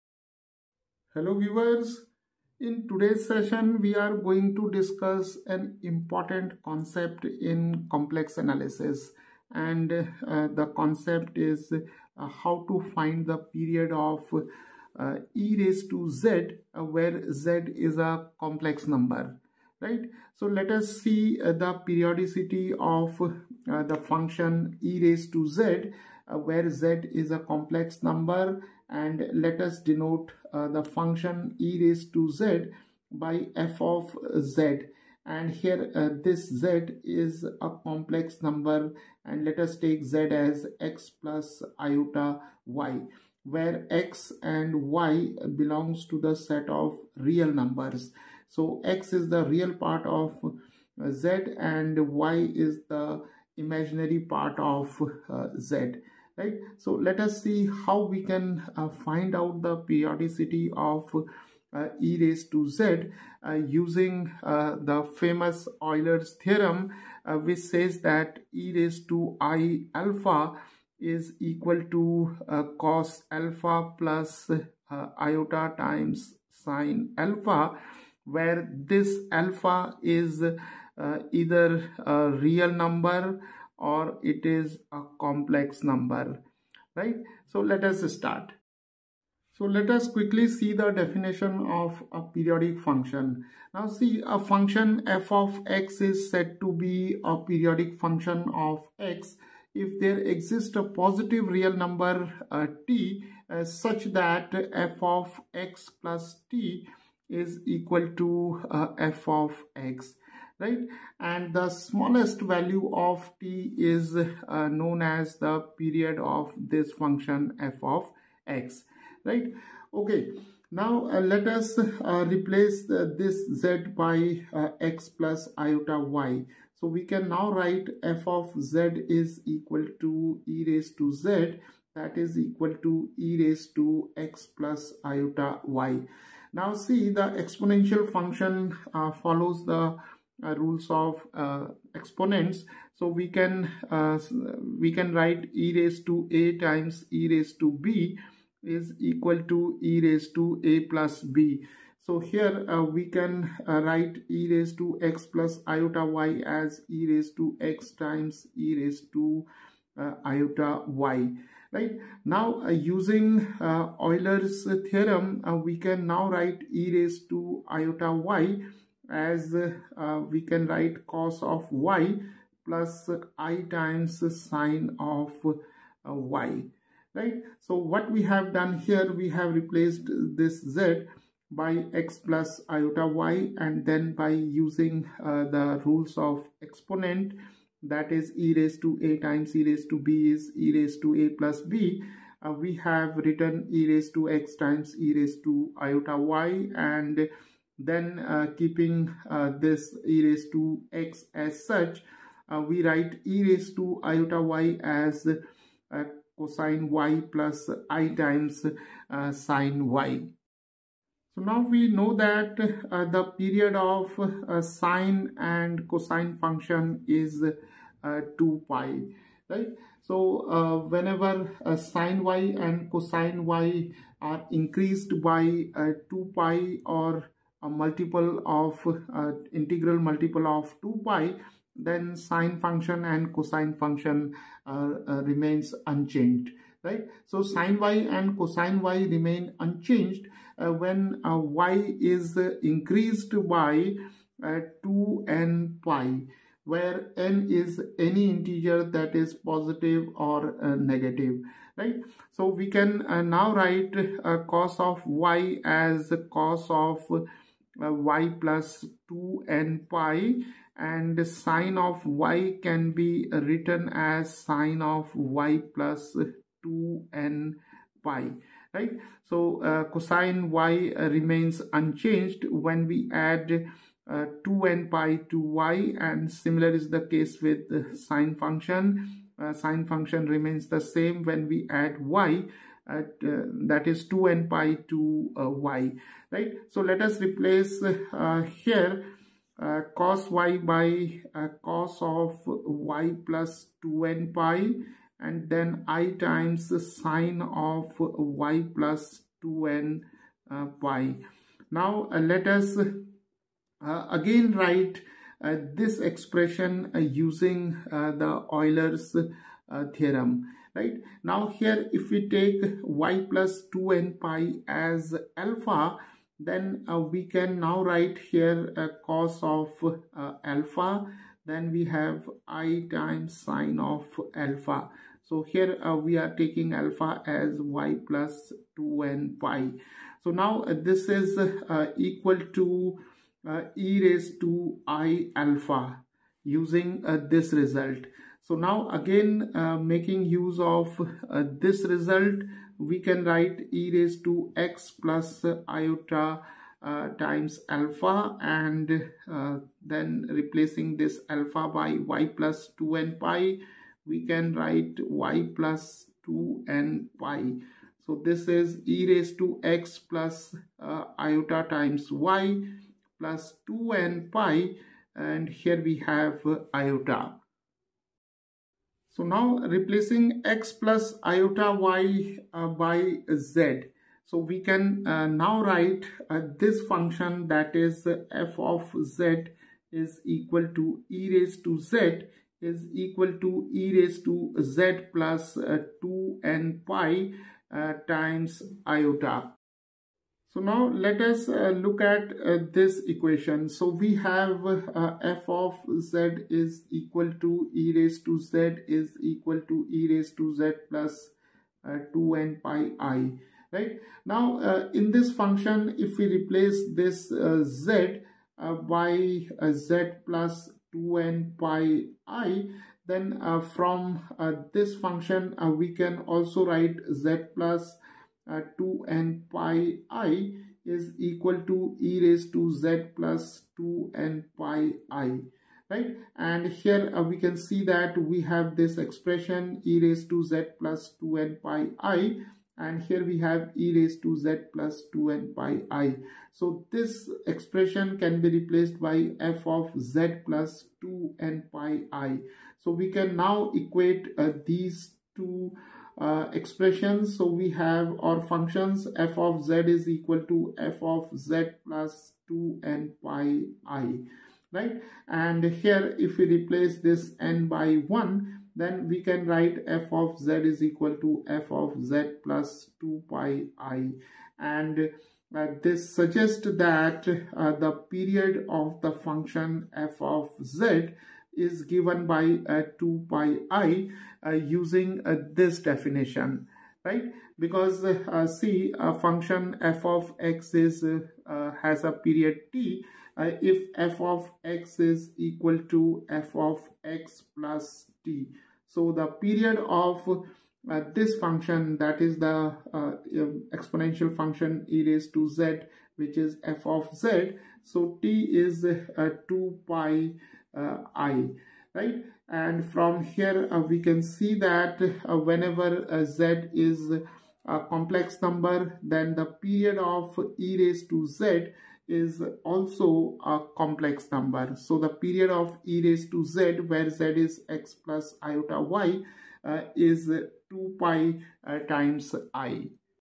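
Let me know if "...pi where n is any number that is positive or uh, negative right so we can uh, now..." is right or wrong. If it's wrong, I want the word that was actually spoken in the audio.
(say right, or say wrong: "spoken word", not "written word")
wrong: "integer", not "number".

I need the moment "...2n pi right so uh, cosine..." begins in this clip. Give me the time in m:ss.
4:26.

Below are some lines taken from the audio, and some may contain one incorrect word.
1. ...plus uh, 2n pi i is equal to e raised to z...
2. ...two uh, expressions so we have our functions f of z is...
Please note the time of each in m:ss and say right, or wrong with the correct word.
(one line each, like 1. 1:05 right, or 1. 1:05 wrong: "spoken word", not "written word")
1. 6:57 right
2. 7:25 right.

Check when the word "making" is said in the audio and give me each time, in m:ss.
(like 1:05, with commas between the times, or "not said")
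5:39.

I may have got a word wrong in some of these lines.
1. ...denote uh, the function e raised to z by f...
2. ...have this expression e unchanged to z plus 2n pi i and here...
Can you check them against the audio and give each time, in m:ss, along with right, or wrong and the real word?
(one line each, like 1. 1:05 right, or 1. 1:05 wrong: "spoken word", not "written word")
1. 0:29 right
2. 7:08 wrong: "raised", not "unchanged".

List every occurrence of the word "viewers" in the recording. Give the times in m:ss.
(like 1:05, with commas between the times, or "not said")
0:01.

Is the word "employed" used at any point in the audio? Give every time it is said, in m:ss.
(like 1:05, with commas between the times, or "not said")
not said.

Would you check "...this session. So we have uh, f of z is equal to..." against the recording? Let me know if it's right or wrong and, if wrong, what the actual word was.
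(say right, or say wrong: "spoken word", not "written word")
wrong: "equation", not "session".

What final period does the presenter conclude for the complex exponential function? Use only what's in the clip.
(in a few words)
2 pi i.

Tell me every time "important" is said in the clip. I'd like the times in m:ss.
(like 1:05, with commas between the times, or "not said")
0:05.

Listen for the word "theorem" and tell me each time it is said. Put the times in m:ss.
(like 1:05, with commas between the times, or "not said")
1:06, 2:44, 5:09.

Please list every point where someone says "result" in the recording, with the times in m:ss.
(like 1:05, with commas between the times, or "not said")
5:37, 5:41.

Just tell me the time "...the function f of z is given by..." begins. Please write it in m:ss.
7:49.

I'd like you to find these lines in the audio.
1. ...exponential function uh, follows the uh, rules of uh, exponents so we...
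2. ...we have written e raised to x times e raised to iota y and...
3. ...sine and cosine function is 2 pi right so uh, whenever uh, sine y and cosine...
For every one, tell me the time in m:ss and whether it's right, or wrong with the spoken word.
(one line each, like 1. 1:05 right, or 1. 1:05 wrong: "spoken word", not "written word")
1. 2:17 right
2. 3:12 right
3. 3:34 right.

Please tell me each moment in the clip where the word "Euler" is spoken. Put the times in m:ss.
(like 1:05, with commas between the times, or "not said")
1:05, 2:43, 5:08.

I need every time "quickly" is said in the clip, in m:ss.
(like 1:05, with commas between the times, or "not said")
1:30.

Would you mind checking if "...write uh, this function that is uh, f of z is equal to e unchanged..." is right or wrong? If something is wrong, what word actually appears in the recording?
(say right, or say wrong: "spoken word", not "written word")
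wrong: "raised", not "unchanged".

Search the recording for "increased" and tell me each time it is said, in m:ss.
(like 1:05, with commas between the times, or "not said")
3:44, 4:02.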